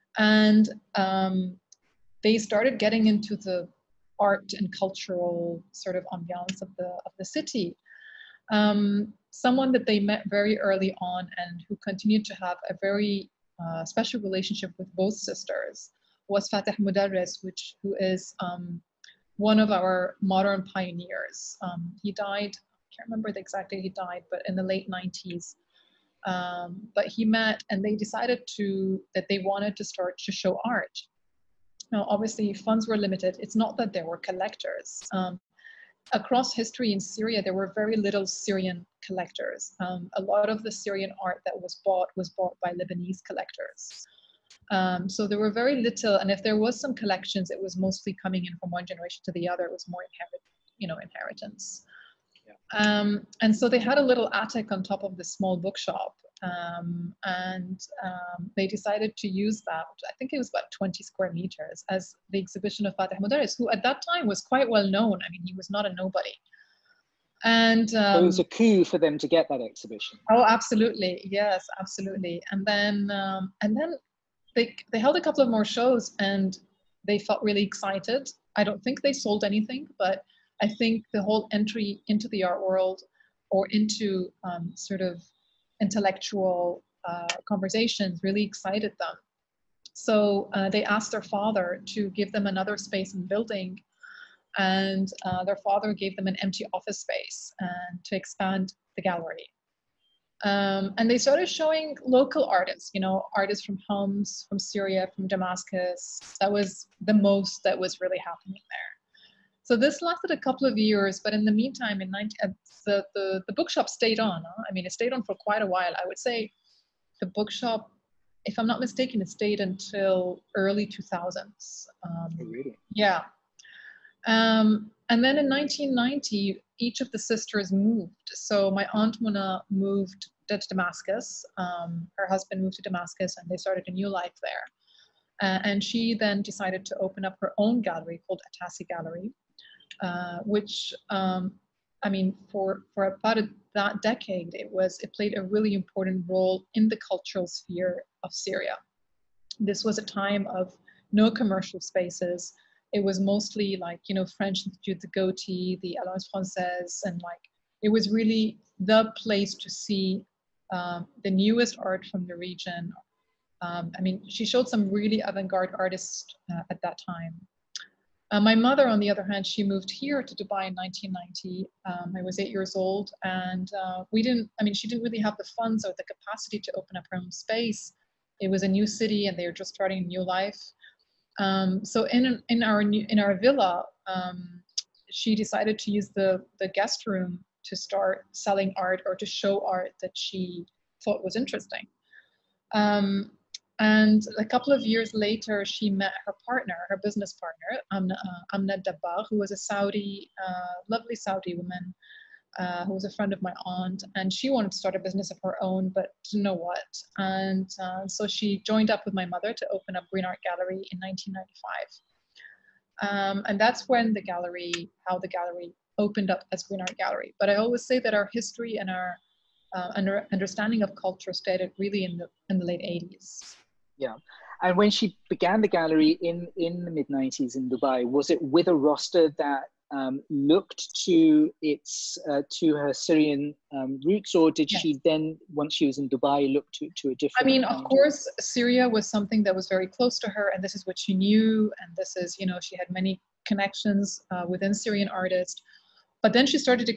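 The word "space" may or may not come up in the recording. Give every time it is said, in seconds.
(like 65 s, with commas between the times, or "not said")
92 s, 97 s, 151 s, 177 s.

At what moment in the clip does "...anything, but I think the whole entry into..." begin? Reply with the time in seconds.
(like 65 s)
79 s.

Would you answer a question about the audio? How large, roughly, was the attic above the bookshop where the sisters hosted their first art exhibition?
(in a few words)
20 square meters.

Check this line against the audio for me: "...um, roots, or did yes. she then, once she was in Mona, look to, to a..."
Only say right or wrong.
wrong.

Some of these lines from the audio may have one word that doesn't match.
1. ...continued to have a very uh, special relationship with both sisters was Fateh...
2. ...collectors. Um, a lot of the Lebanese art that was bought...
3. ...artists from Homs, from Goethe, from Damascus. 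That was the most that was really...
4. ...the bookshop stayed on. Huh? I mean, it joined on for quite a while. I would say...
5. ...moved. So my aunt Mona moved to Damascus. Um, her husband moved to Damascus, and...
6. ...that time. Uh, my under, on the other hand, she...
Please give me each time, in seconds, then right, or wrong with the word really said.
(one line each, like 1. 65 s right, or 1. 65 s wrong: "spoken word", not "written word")
1. 11 s right
2. 39 s wrong: "Syrian", not "Lebanese"
3. 103 s wrong: "Syria", not "Goethe"
4. 113 s wrong: "stayed", not "joined"
5. 127 s right
6. 166 s wrong: "mother", not "under".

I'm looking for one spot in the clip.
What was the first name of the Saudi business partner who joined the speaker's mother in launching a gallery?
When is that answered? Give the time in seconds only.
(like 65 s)
198 s.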